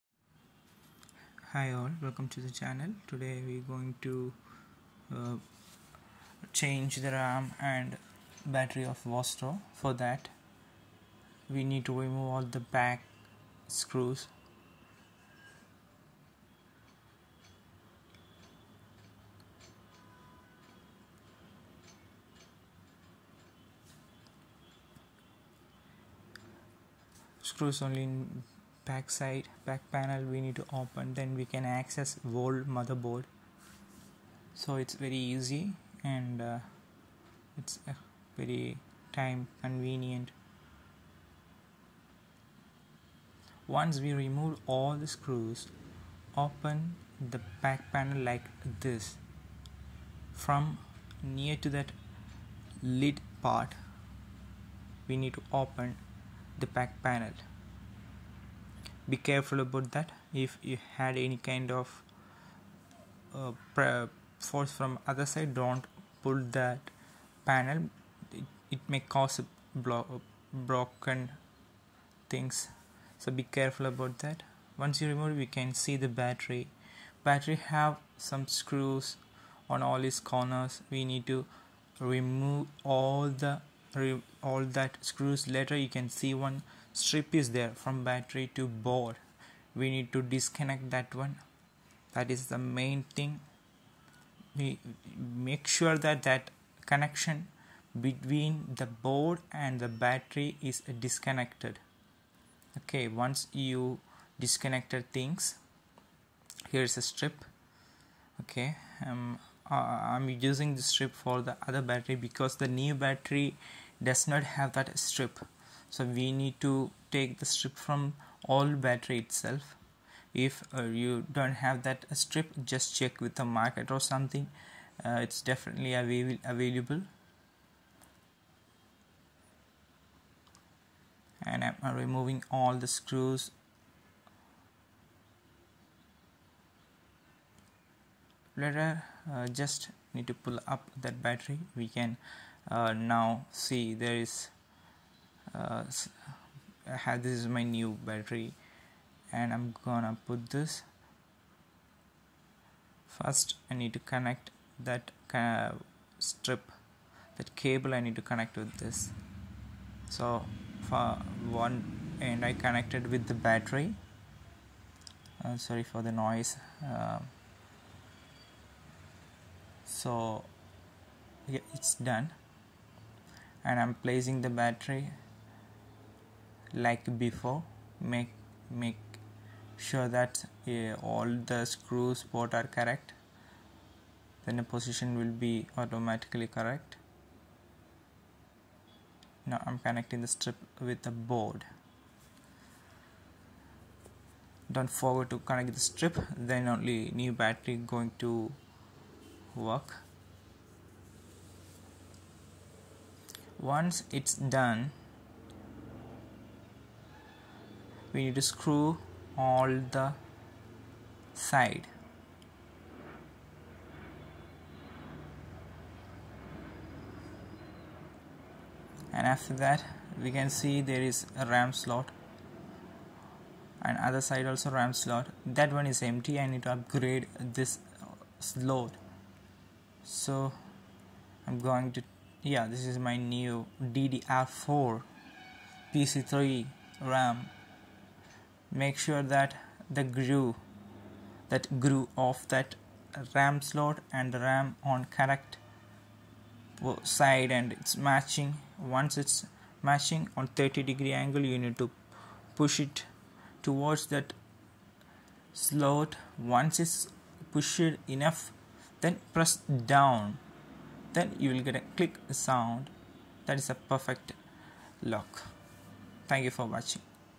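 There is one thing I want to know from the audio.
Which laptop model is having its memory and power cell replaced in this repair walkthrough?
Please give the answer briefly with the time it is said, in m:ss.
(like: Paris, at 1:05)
Vostro, at 0:09.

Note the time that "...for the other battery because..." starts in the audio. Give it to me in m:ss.
1:51.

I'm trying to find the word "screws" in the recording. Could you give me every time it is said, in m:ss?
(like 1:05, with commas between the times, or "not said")
0:13, 0:27, 0:45, 1:18, 1:25, 2:12, 3:01, 3:28.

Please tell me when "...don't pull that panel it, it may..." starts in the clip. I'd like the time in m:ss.
1:05.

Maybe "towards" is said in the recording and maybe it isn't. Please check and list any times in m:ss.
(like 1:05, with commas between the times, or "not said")
4:13.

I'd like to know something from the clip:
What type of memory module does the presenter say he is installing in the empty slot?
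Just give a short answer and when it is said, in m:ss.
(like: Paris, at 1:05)
DDR4 PC3, at 3:53.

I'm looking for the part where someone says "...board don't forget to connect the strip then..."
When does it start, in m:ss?
3:11.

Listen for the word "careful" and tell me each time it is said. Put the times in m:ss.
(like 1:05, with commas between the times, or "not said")
0:59, 1:13.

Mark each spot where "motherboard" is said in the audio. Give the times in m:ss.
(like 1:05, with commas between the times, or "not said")
0:32.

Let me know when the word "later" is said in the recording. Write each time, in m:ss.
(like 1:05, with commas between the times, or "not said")
1:25, 2:18.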